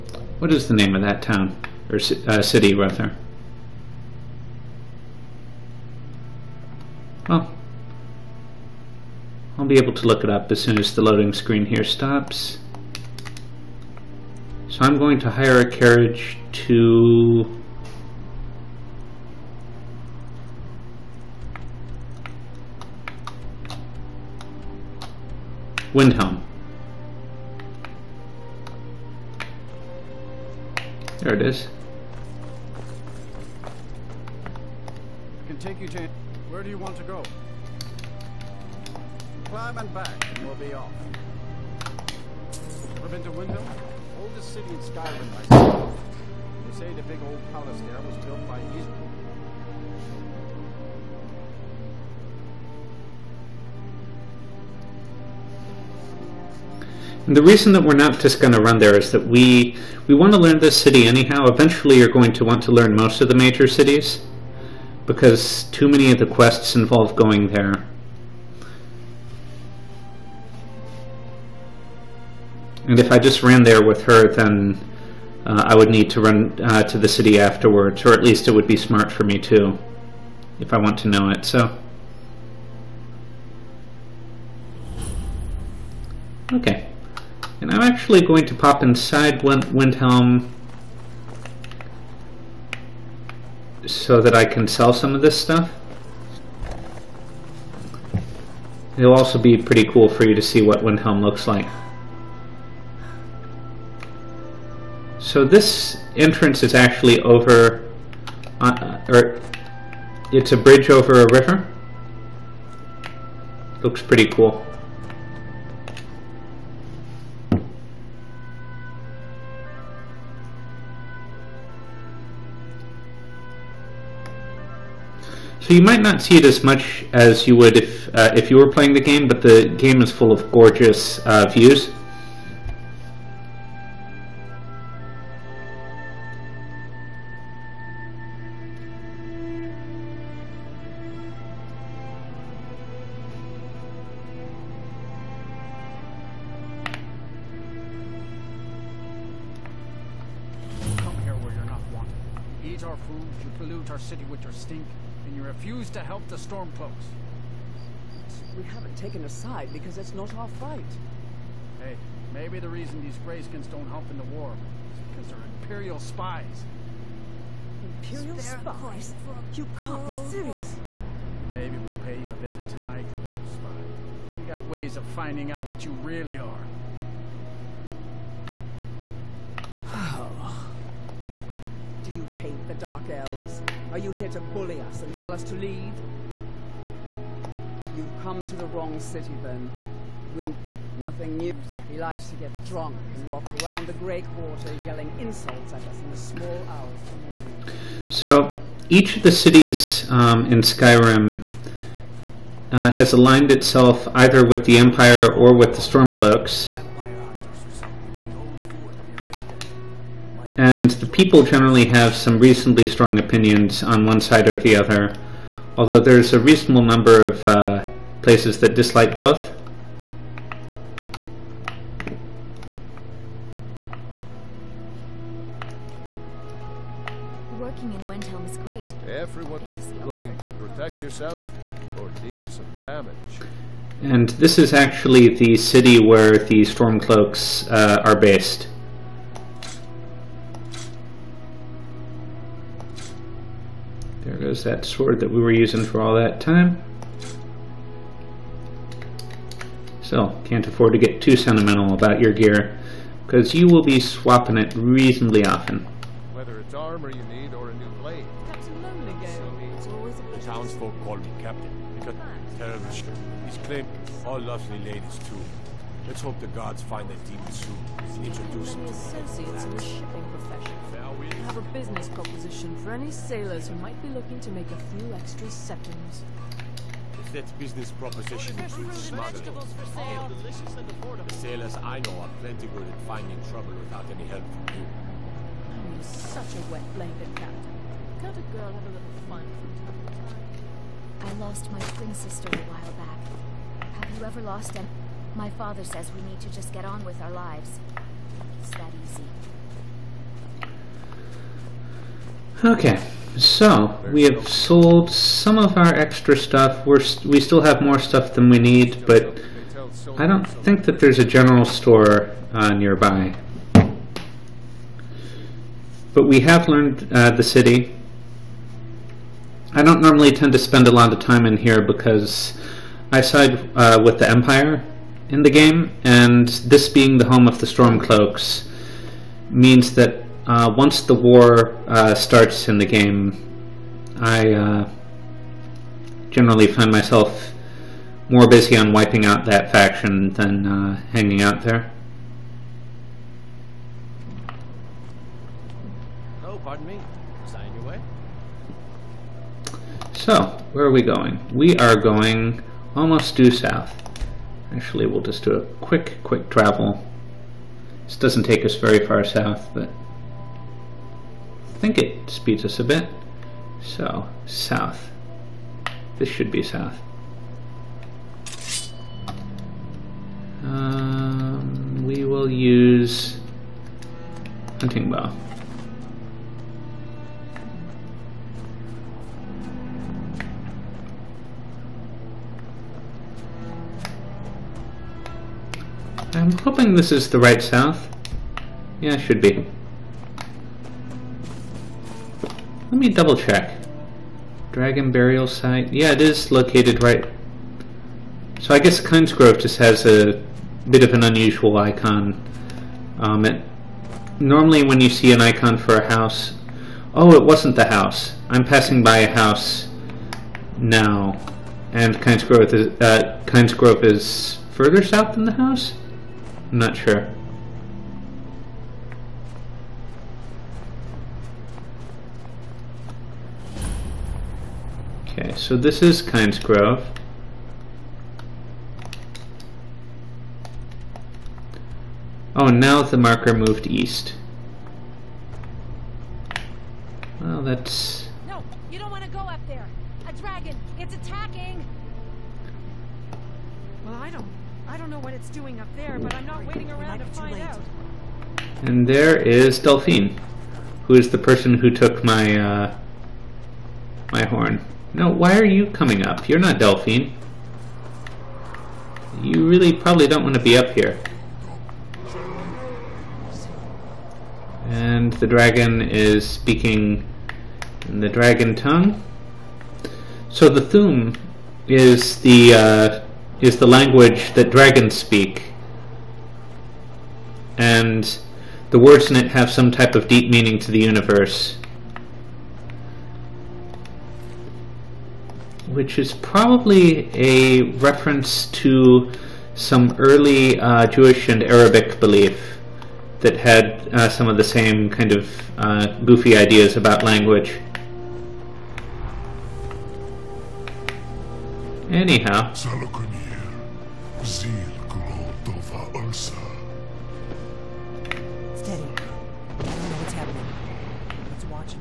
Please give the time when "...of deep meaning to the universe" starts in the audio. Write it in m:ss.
8:00.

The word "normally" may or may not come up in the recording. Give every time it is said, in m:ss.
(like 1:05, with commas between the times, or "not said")
5:19, 6:44.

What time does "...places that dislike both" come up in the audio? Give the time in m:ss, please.
3:38.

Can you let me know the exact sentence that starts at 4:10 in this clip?
So, can't afford to get too sentimental about your gear, because you will be swapping it reasonably often.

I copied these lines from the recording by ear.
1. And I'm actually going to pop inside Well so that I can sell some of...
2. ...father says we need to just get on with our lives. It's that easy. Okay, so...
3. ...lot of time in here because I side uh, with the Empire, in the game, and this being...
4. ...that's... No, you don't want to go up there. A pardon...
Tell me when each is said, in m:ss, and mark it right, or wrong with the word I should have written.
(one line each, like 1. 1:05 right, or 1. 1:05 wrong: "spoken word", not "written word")
1. 1:27 wrong: "Windhelm", not "Well"
2. 4:55 right
3. 5:20 right
4. 7:17 wrong: "dragon", not "pardon".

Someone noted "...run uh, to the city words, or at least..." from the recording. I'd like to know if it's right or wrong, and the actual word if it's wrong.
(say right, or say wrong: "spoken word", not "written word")
wrong: "afterwards", not "words".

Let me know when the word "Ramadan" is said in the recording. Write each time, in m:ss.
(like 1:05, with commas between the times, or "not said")
not said.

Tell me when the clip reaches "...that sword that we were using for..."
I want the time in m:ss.
4:04.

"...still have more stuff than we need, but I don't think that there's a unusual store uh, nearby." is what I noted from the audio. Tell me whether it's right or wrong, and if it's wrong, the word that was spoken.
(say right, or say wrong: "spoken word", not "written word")
wrong: "general", not "unusual".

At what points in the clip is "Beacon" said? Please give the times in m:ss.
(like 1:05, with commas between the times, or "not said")
not said.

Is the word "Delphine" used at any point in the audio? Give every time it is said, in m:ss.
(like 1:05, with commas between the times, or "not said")
7:29, 7:36.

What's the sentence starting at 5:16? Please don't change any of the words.
But we have learned uh, the city.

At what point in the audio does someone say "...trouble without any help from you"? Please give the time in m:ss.
4:43.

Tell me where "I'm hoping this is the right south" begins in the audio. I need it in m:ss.
6:26.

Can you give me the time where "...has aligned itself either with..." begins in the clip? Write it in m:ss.
3:22.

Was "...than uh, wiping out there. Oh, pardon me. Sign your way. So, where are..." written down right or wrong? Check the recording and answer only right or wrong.
wrong.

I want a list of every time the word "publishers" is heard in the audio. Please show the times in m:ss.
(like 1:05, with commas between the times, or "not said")
not said.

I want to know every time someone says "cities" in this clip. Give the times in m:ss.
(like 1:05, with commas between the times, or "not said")
1:03, 3:19.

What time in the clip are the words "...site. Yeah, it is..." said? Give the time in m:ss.
6:35.